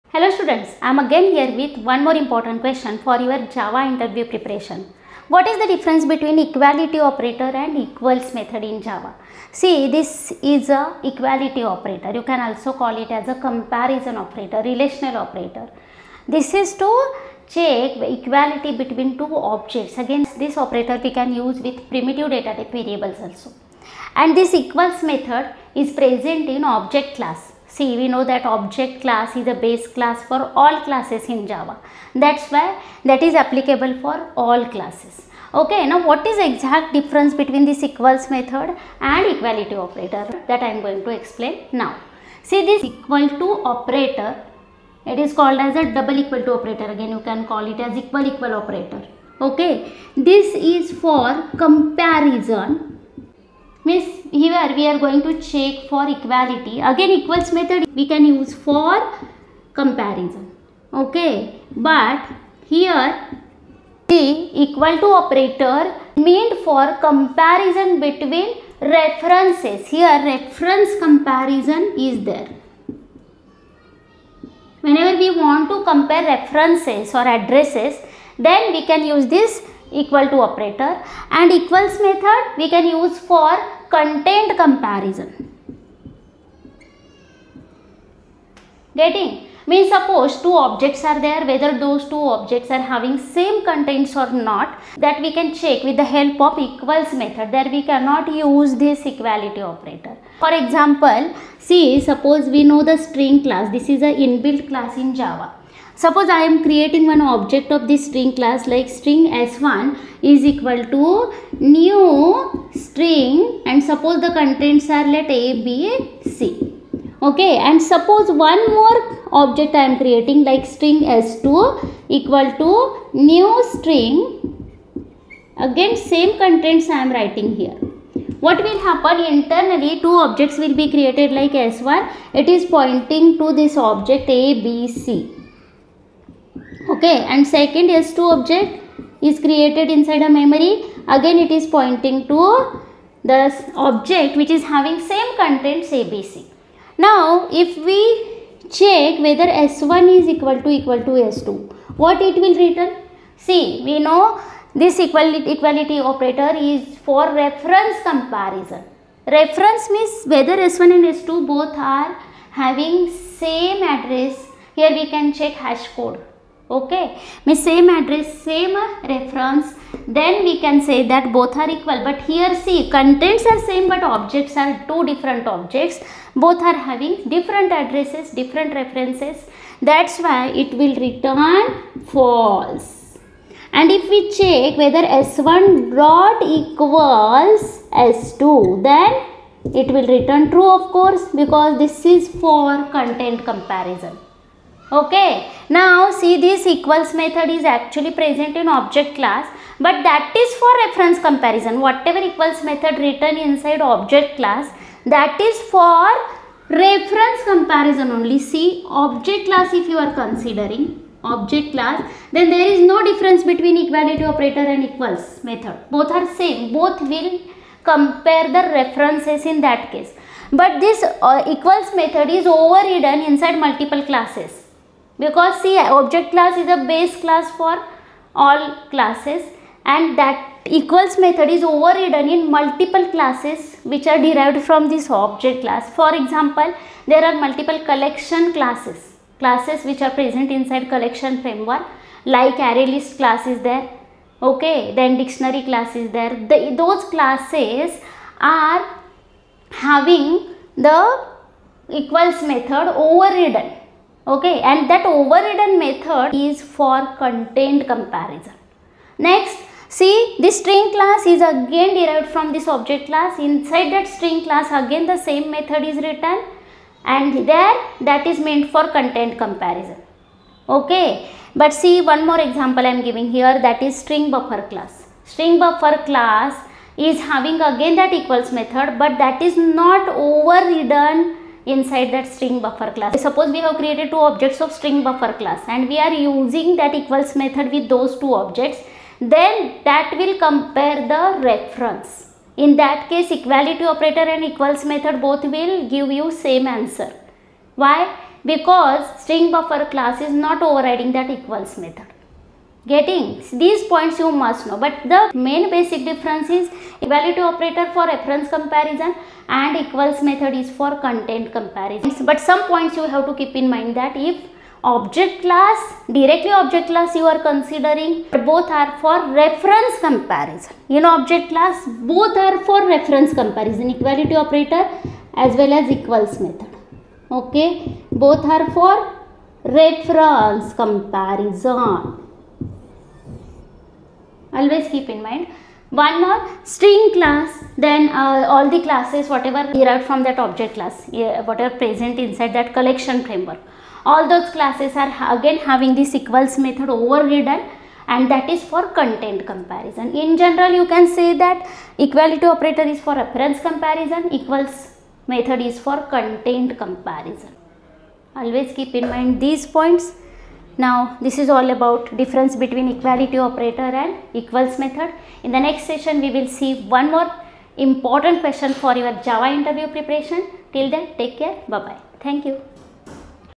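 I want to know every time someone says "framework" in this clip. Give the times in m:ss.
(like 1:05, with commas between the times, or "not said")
4:01, 5:43.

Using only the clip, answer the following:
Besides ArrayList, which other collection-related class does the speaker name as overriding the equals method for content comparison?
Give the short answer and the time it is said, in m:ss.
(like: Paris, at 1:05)
Dictionary, at 4:05.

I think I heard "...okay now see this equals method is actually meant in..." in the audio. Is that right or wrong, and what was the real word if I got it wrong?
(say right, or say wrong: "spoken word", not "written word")
wrong: "present", not "meant".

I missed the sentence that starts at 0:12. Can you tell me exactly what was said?
You can also call it as a comparison operator, relational operator.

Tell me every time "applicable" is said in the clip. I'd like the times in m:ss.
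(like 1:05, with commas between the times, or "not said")
0:33.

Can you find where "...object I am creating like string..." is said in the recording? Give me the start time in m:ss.
1:59.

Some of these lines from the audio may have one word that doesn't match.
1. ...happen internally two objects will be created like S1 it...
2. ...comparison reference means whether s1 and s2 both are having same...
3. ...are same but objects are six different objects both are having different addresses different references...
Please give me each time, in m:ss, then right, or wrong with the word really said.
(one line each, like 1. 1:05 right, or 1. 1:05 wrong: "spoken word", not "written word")
1. 2:08 right
2. 2:38 right
3. 2:53 wrong: "two", not "six".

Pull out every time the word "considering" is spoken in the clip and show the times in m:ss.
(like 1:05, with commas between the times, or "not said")
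3:30, 5:17.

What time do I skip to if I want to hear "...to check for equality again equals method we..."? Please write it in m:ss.
0:55.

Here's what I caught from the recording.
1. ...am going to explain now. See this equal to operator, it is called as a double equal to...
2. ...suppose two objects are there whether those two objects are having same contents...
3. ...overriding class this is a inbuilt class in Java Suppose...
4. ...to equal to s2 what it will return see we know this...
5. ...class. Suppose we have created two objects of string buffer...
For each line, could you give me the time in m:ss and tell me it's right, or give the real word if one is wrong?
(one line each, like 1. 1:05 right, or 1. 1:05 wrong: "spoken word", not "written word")
1. 0:40 right
2. 1:29 right
3. 1:42 wrong: "string", not "overriding"
4. 2:30 right
5. 4:42 right.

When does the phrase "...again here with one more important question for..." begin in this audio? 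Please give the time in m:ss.
0:00.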